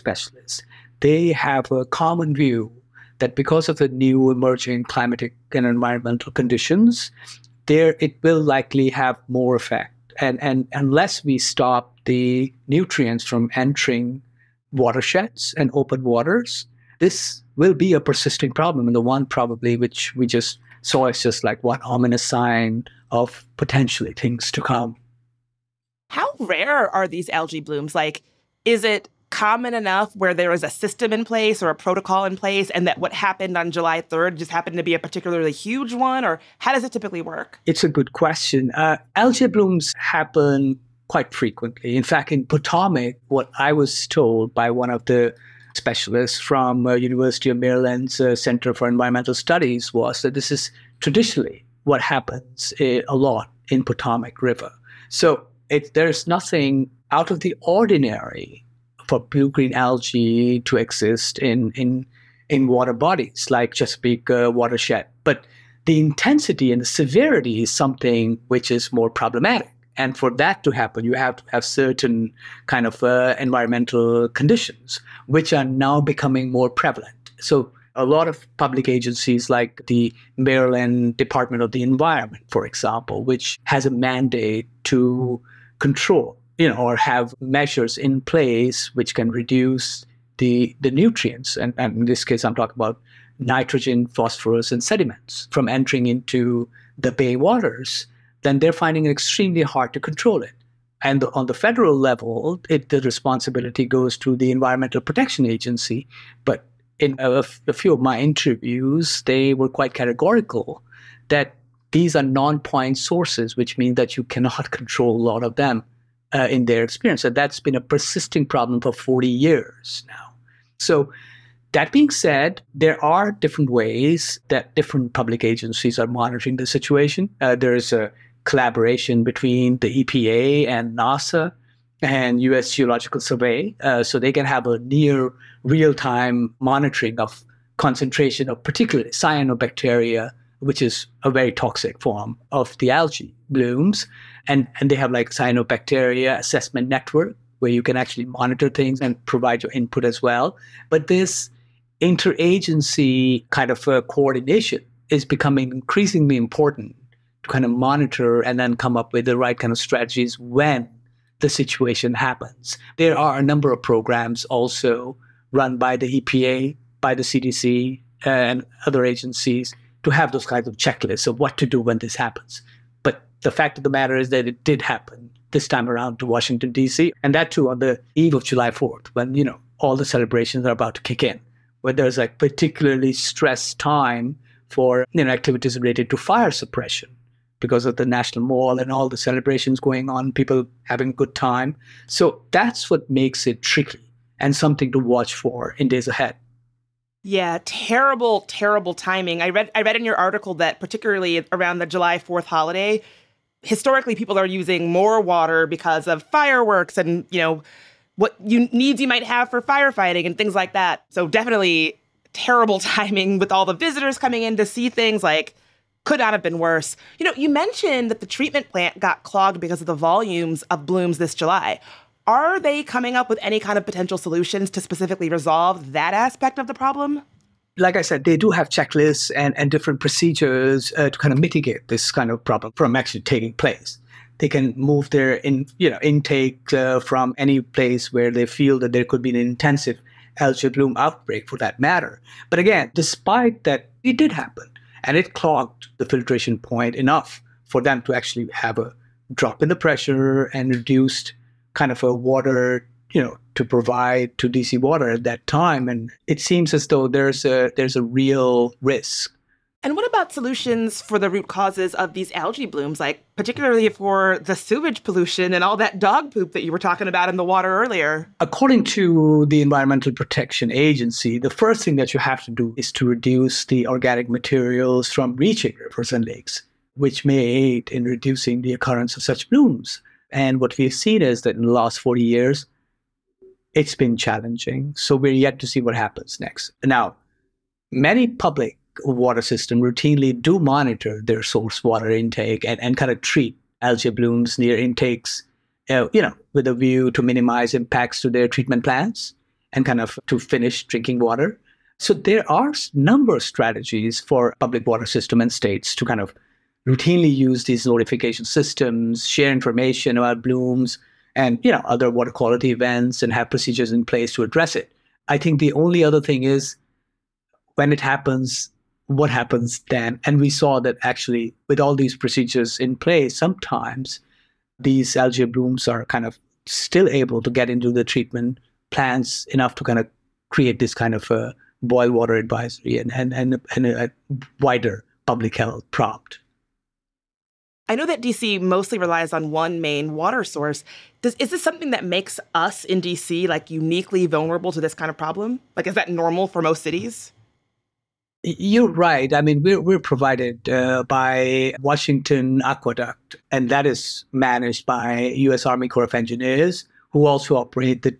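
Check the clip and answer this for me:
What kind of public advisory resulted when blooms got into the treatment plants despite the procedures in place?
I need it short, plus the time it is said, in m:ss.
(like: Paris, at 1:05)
boil water advisory, at 5:31.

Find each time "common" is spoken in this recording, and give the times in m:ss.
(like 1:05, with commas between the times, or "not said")
0:01, 0:29.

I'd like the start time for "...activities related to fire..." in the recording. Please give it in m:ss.
3:05.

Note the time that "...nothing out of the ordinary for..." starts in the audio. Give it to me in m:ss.
0:56.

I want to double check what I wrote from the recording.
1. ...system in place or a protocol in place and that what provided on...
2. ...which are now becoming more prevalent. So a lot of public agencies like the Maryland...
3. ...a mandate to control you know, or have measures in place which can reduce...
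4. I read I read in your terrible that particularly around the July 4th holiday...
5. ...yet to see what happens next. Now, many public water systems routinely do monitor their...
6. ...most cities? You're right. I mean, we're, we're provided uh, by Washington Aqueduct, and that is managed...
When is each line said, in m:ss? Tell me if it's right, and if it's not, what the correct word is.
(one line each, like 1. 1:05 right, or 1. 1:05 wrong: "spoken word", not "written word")
1. 0:30 wrong: "happened", not "provided"
2. 1:15 right
3. 1:23 right
4. 3:19 wrong: "article", not "terrible"
5. 4:45 right
6. 5:46 right.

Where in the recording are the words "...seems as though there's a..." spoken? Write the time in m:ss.
4:16.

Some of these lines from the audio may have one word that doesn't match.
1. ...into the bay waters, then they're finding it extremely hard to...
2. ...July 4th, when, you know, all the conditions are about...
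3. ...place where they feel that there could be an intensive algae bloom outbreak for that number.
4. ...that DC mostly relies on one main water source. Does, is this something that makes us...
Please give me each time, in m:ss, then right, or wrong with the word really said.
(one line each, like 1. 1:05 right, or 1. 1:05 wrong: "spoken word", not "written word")
1. 1:36 right
2. 2:58 wrong: "celebrations", not "conditions"
3. 3:57 wrong: "matter", not "number"
4. 5:38 right.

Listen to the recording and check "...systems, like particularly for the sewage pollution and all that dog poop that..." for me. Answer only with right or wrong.
wrong.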